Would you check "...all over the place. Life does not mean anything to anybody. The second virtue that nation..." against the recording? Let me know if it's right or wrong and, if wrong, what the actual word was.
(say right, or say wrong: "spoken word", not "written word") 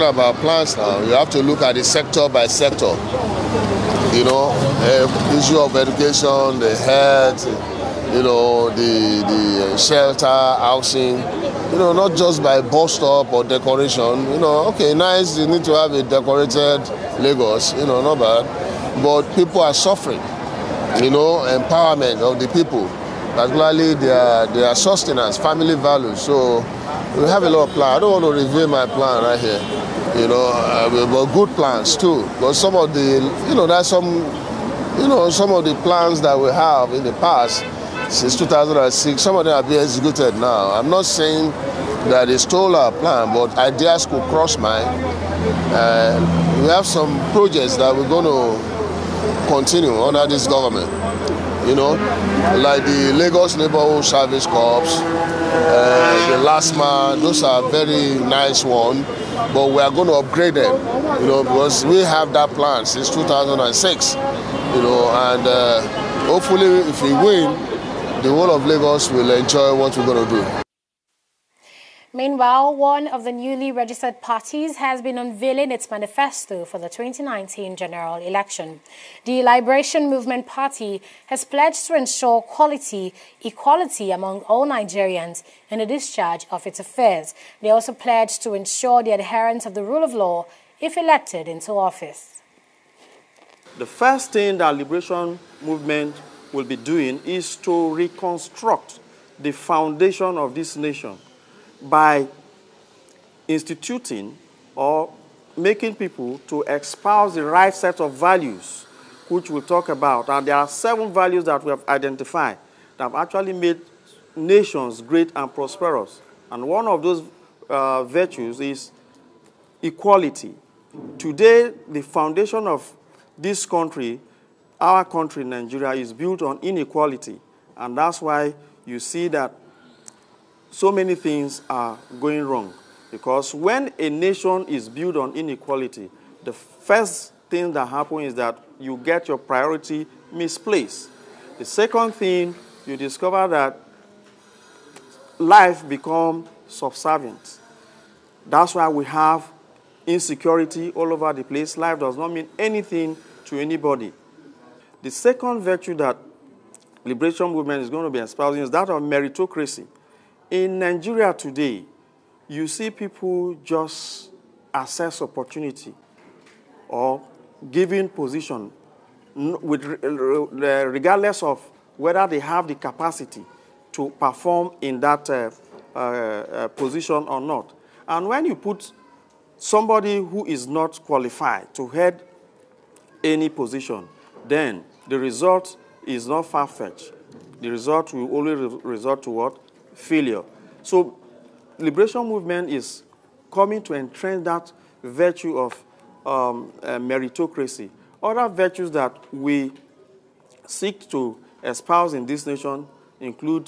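wrong: "liberation", not "nation".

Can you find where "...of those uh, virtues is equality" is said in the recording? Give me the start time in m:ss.
1:56.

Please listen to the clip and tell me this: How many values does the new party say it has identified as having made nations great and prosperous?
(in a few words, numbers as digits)
7.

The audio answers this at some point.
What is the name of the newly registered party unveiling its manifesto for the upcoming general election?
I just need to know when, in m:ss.
1:19.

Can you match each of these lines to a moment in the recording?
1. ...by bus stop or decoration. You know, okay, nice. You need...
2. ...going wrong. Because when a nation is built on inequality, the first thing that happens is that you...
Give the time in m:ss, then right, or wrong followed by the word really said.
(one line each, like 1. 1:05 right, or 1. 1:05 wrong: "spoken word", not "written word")
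1. 0:12 right
2. 2:12 right.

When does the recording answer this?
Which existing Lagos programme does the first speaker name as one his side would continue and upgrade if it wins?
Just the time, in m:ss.
0:53.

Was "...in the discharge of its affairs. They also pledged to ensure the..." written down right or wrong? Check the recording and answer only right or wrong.
right.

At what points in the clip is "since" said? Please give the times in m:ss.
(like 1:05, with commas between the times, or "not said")
0:38, 1:02.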